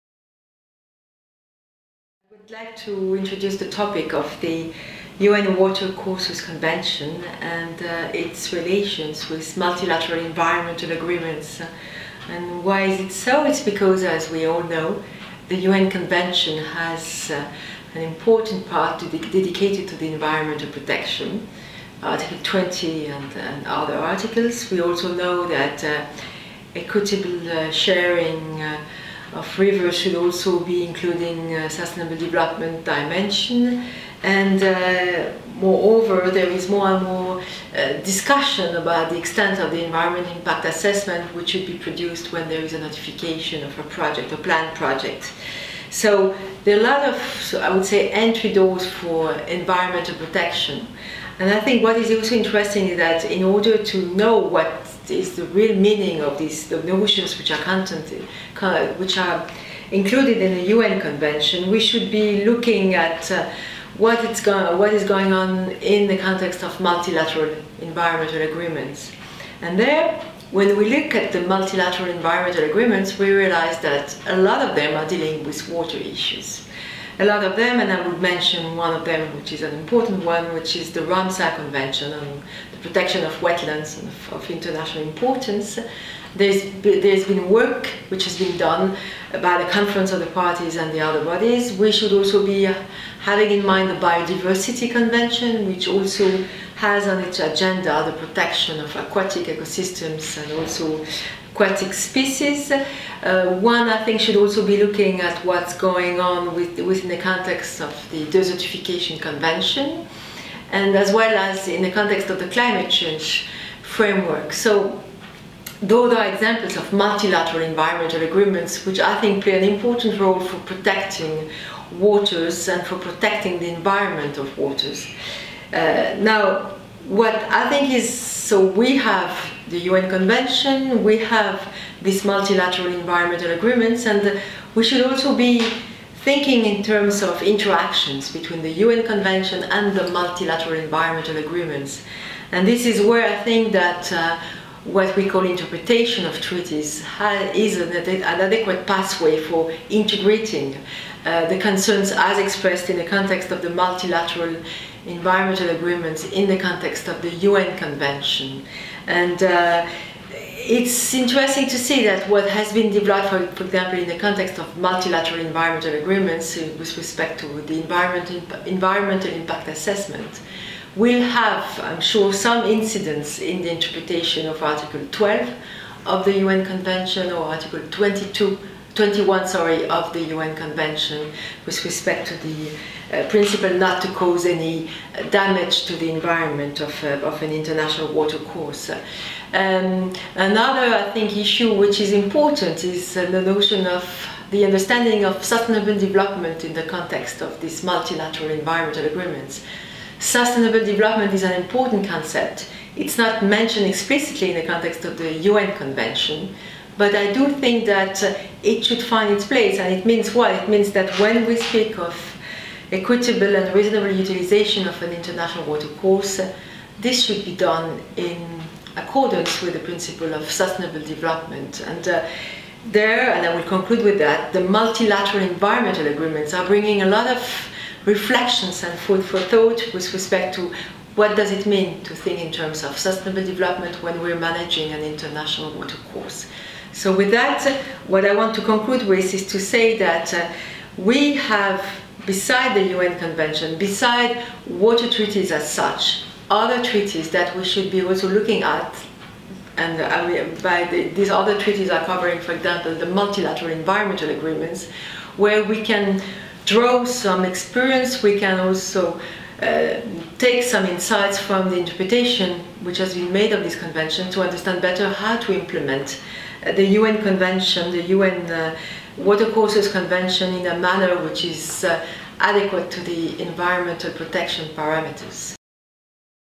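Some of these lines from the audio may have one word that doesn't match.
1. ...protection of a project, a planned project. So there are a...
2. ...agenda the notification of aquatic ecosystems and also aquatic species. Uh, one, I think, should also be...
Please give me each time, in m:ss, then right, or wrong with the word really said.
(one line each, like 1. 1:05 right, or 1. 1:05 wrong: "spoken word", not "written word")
1. 0:42 wrong: "notification", not "protection"
2. 1:37 wrong: "protection", not "notification".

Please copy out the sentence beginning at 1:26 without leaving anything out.
There's, there's been work which has been done by the Conference of the Parties and the other bodies.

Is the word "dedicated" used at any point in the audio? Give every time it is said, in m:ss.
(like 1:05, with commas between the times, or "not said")
0:19.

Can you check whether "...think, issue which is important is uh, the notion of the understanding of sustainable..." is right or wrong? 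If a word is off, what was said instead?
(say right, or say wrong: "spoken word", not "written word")
right.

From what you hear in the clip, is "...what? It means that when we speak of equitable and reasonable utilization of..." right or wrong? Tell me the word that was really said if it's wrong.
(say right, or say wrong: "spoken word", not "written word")
right.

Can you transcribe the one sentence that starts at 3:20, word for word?
Sustainable development is an important concept.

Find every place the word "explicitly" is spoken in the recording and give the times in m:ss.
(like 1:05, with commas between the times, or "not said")
3:23.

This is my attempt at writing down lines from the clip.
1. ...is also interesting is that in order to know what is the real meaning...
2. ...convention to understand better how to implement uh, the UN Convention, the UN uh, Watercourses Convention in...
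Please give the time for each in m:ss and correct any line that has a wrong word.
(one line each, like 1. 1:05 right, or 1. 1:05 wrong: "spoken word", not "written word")
1. 0:51 right
2. 4:23 right.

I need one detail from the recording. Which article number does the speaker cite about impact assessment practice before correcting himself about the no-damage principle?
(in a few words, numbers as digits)
Article 12.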